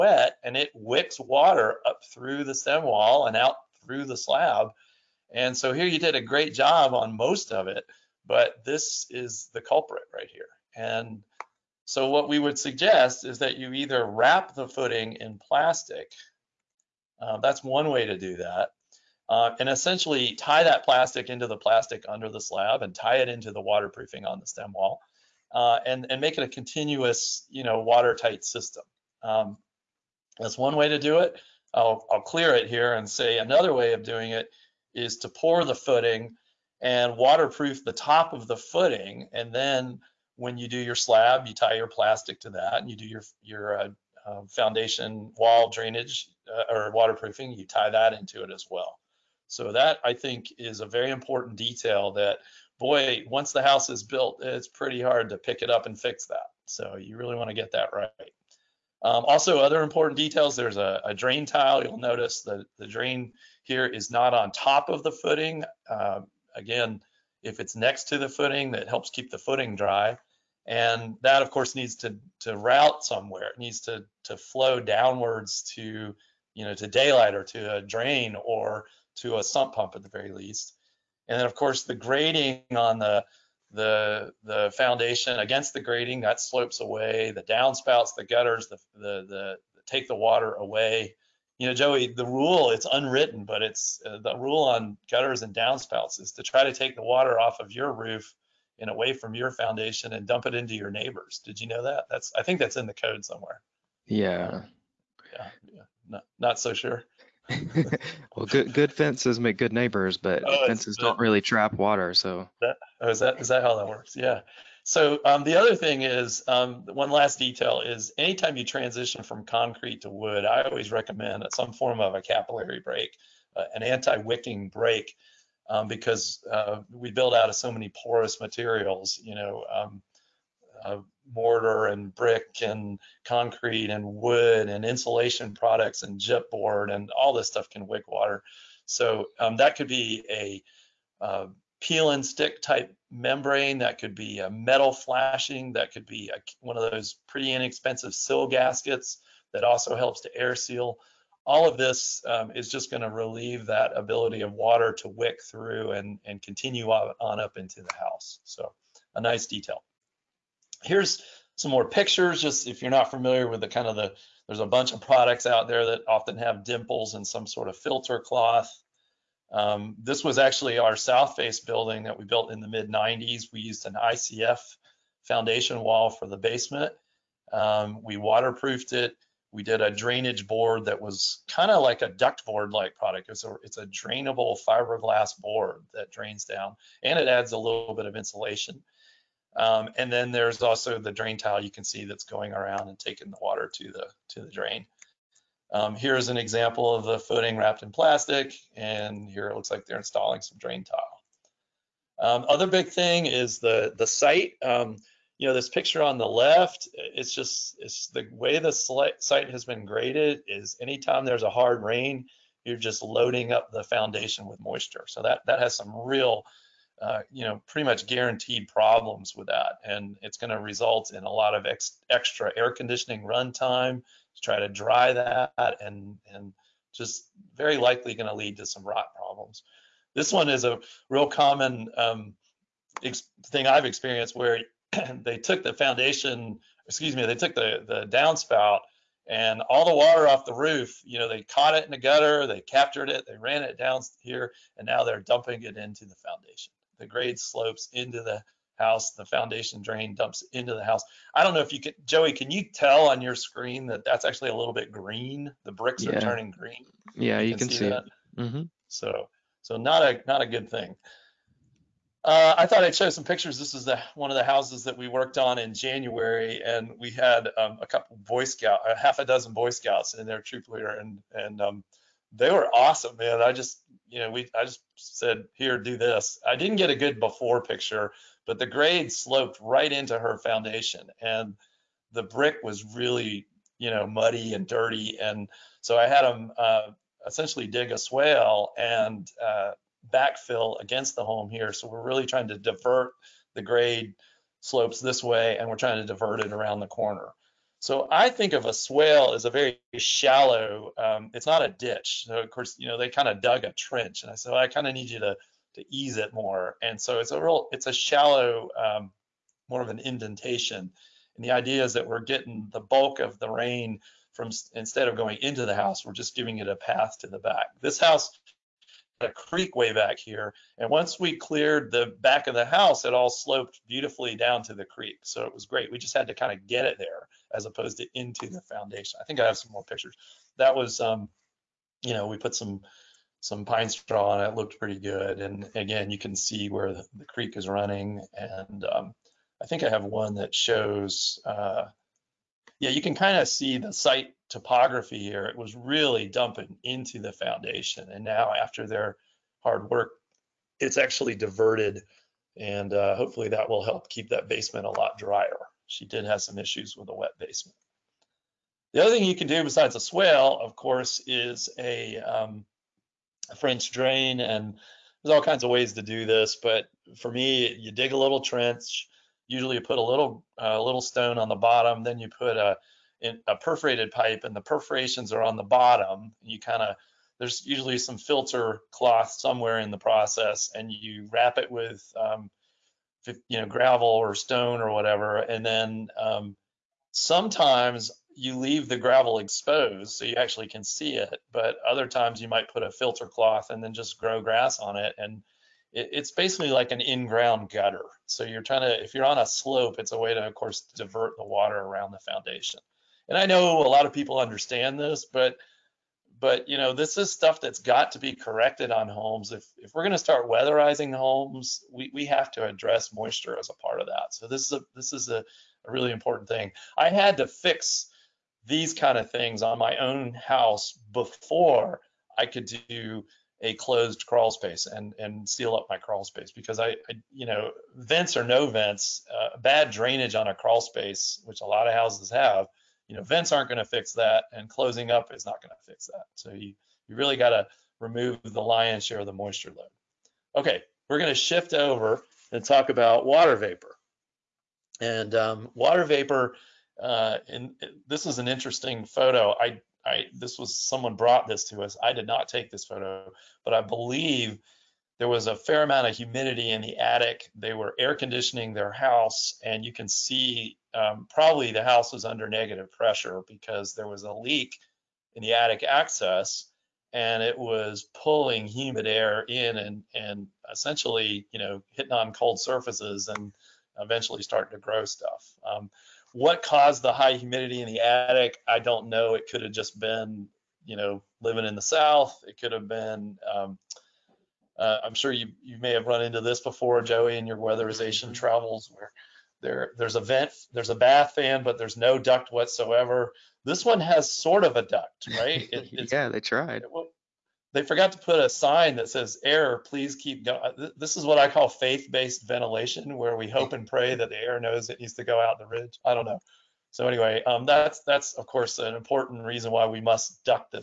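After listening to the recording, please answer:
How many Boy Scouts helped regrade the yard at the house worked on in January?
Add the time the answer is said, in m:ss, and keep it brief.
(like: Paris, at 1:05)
half a dozen, at 4:28.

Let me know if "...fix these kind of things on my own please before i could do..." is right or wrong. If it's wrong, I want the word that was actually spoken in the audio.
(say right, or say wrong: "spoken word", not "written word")
wrong: "house", not "please".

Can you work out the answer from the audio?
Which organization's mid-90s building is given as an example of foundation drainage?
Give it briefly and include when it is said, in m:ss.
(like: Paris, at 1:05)
Southface, at 2:50.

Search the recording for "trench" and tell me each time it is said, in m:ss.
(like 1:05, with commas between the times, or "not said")
5:03, 6:08.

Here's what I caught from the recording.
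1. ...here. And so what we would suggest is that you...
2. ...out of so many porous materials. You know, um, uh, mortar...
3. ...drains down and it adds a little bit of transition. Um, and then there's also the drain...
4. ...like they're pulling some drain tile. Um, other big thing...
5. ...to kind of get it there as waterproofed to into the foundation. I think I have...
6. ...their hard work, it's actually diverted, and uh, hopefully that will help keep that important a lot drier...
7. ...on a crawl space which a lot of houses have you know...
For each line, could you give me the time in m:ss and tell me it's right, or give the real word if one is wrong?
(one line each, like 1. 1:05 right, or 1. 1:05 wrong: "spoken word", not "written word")
1. 0:10 right
2. 2:07 right
3. 3:06 wrong: "insulation", not "transition"
4. 3:19 wrong: "installing", not "pulling"
5. 5:26 wrong: "opposed", not "waterproofed"
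6. 5:48 wrong: "basement", not "important"
7. 7:10 right.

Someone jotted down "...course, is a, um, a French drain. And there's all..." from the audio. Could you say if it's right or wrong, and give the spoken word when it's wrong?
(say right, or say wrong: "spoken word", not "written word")
right.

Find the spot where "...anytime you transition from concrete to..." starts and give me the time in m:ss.
1:58.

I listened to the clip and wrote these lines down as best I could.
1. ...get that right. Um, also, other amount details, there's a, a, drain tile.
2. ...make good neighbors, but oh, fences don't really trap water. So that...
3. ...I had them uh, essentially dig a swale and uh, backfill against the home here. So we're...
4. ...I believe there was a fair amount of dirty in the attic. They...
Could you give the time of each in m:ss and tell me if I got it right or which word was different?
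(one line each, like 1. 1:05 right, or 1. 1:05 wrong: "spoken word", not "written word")
1. 0:57 wrong: "important", not "amount"
2. 1:49 right
3. 4:45 right
4. 7:33 wrong: "humidity", not "dirty".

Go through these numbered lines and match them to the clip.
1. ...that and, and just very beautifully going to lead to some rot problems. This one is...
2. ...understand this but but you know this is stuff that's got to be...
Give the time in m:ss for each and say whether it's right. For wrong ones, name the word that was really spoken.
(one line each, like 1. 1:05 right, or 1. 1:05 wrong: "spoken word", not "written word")
1. 3:45 wrong: "likely", not "beautifully"
2. 6:44 right.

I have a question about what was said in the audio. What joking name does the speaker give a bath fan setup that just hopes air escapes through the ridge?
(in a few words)
faith-based ventilation.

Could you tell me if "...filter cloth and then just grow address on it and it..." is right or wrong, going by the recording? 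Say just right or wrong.
wrong.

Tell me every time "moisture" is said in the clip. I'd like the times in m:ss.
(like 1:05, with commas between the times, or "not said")
3:34, 6:53, 7:19.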